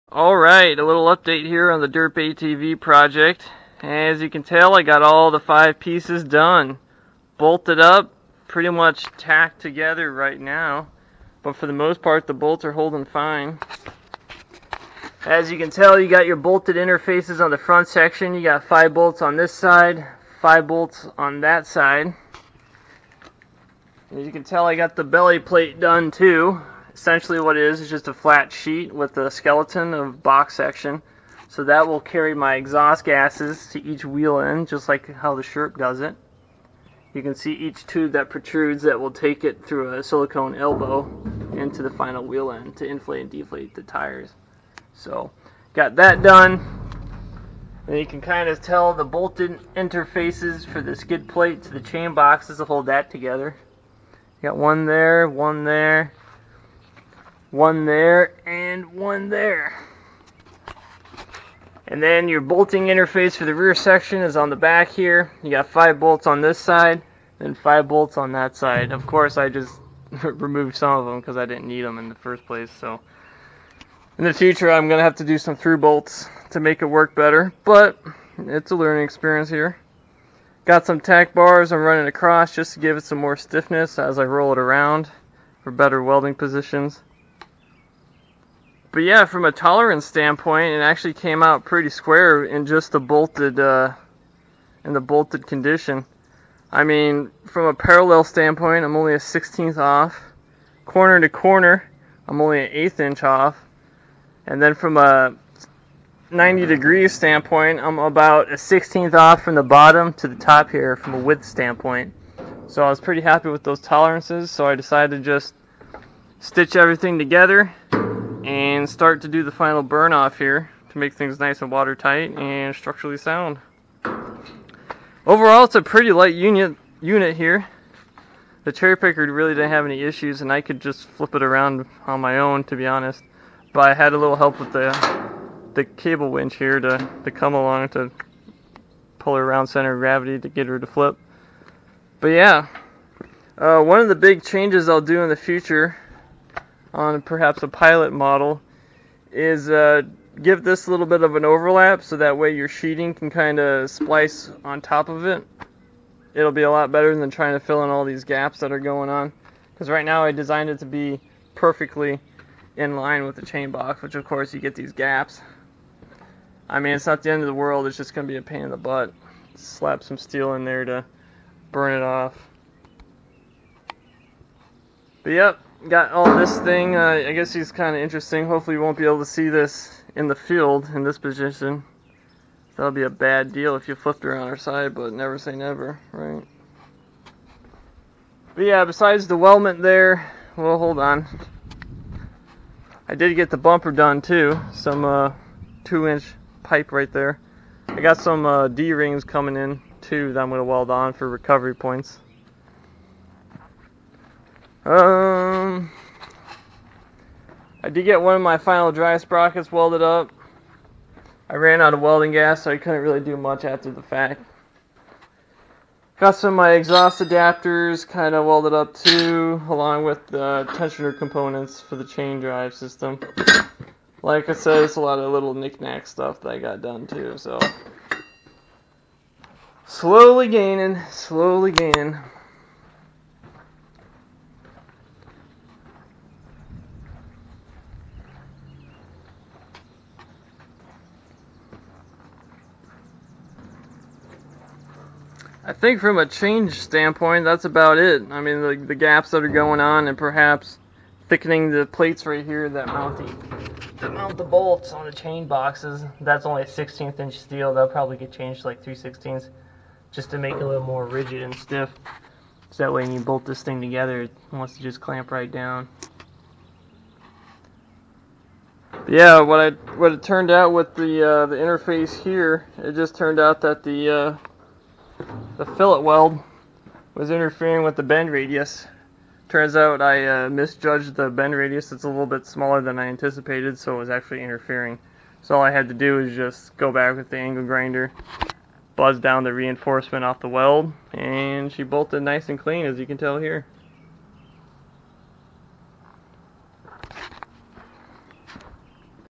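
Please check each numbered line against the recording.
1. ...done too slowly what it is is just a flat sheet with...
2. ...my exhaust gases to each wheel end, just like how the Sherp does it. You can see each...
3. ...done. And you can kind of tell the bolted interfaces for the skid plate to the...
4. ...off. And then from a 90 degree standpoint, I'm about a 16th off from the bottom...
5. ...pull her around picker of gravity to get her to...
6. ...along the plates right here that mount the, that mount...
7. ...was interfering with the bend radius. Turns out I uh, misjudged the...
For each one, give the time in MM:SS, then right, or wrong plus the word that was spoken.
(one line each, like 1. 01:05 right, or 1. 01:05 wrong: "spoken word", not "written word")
1. 00:25 wrong: "essentially", not "slowly"
2. 00:32 right
3. 00:46 right
4. 01:43 right
5. 02:19 wrong: "center", not "picker"
6. 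04:11 wrong: "thickening", not "along"
7. 04:37 right.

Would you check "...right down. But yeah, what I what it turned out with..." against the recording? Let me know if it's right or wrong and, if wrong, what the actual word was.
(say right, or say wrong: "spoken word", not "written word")
right.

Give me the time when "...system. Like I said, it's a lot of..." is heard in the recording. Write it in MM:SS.
03:42.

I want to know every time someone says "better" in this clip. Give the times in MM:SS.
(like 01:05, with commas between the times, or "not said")
01:17, 01:25, 02:36.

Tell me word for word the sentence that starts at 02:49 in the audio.
Slap some steel in there to burn it off.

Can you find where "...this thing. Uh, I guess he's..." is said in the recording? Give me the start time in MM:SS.
02:56.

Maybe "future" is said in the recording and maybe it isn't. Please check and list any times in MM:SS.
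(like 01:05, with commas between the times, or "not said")
01:14, 02:25.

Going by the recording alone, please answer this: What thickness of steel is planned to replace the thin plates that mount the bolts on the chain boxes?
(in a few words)
3/16 inch.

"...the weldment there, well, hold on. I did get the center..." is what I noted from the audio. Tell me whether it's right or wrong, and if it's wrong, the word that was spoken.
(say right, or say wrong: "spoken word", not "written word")
wrong: "bumper", not "center".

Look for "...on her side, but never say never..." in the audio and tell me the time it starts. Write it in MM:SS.
03:04.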